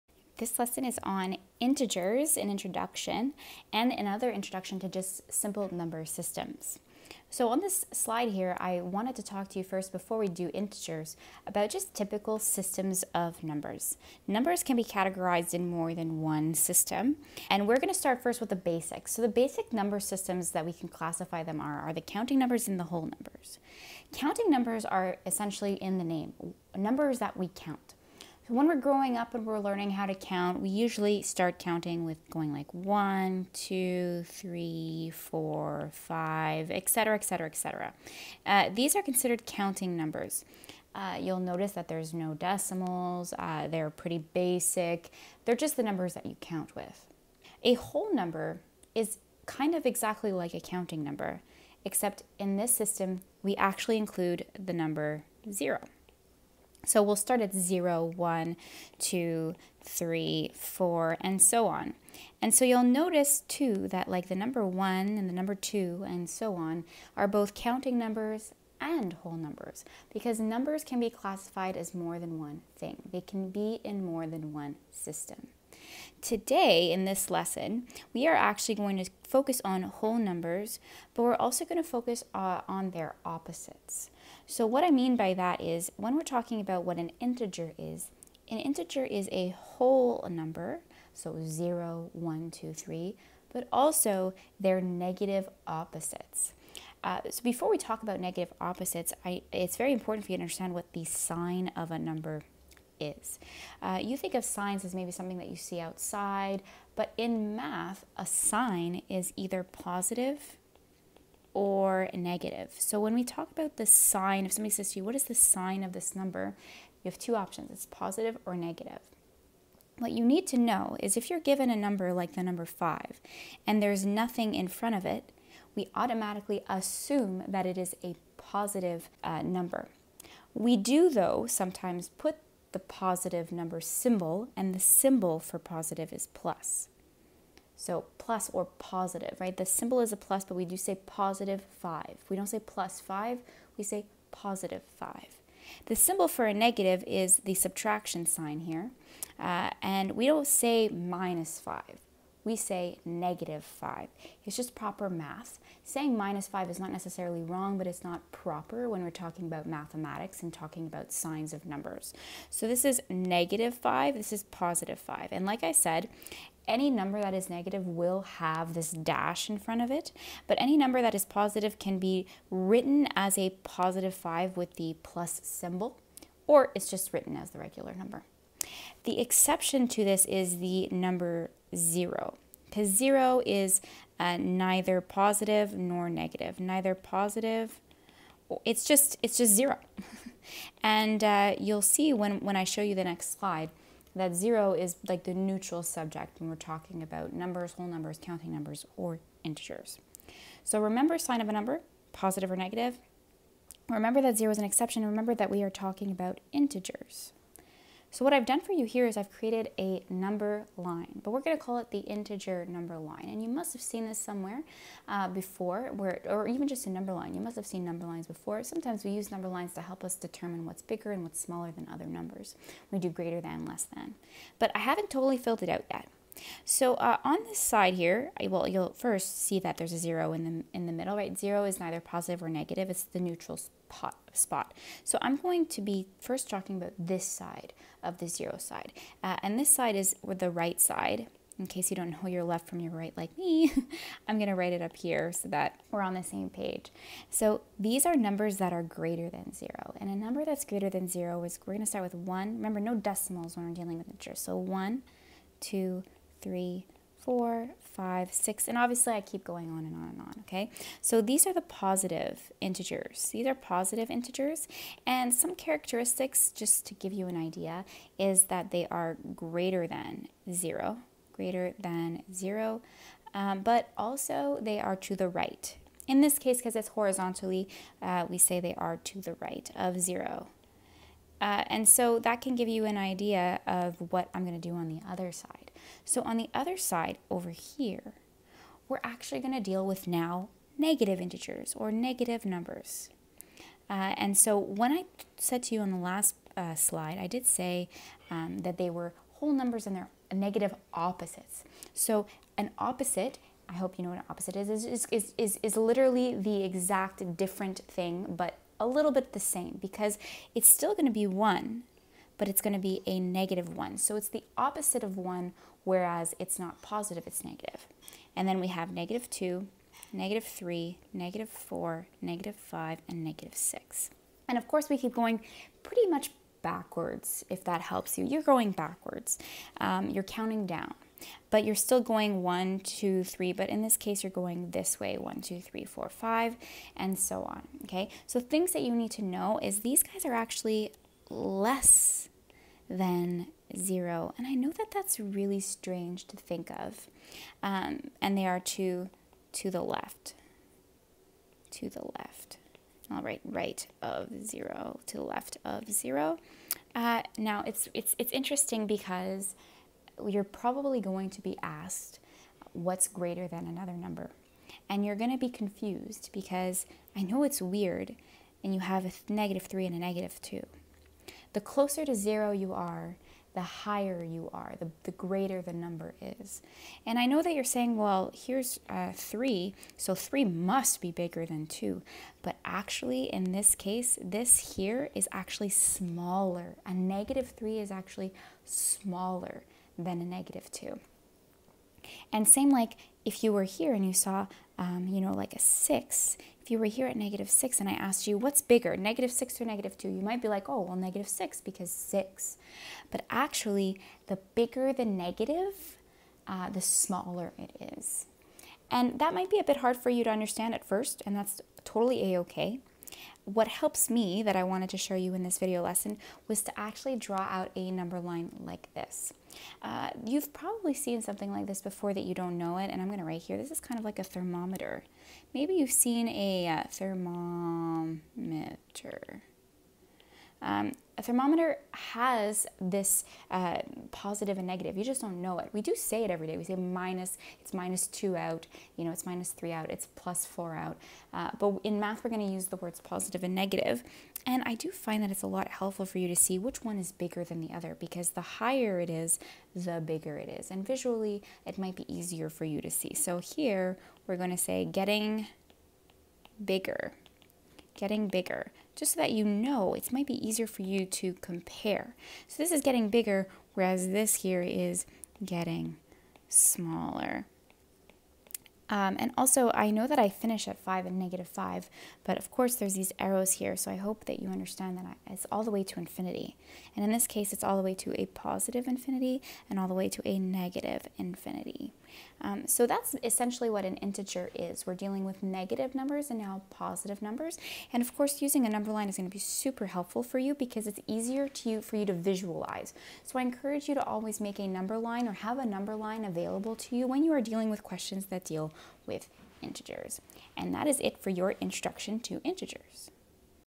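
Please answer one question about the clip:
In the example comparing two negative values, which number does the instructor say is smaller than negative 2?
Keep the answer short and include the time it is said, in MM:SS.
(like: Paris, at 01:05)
-3, at 06:26.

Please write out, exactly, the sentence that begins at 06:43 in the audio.
But actually, the bigger the negative, uh, the smaller it is.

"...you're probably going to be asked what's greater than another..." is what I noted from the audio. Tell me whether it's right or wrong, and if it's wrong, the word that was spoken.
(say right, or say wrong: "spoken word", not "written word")
right.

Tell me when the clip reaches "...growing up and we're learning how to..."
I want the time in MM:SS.
00:28.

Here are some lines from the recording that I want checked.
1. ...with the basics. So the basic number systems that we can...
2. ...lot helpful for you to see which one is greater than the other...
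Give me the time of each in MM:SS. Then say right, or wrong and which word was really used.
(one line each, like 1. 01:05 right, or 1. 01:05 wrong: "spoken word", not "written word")
1. 00:18 right
2. 07:25 wrong: "bigger", not "greater".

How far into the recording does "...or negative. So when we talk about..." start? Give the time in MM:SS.
01:51.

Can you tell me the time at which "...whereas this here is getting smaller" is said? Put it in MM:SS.
07:43.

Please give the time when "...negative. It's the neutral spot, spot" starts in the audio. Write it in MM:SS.
03:52.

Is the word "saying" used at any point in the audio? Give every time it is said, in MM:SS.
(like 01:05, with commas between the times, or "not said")
02:35, 06:17.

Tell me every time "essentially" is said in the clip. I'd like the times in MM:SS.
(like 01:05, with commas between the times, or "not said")
00:25, 08:03.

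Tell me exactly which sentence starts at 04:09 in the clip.
And a number that's greater than zero is, we're going to start with one.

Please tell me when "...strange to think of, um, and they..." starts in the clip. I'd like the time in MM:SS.
05:45.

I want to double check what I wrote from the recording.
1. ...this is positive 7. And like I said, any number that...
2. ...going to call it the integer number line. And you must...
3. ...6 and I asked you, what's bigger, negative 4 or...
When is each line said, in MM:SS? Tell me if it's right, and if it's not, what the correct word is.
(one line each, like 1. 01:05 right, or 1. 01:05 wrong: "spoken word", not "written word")
1. 02:44 wrong: "5", not "7"
2. 03:31 right
3. 06:37 wrong: "6", not "4".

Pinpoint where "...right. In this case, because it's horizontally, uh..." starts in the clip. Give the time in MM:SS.
04:35.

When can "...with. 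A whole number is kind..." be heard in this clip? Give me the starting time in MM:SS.
00:46.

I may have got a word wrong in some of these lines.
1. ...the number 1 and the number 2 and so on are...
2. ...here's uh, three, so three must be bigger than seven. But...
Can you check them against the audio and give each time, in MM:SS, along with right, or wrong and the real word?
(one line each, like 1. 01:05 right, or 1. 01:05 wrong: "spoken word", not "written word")
1. 01:04 right
2. 06:18 wrong: "two", not "seven".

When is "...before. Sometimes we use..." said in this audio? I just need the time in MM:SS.
03:38.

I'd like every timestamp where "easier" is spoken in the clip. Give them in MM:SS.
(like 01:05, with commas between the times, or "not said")
07:32, 07:40, 08:11.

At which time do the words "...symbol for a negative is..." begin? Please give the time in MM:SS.
02:25.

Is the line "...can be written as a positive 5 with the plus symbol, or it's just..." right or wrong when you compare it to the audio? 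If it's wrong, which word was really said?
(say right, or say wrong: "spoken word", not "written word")
right.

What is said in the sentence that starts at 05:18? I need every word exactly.
And then we have negative 2, negative 3, negative 4, negative 5, and negative 6.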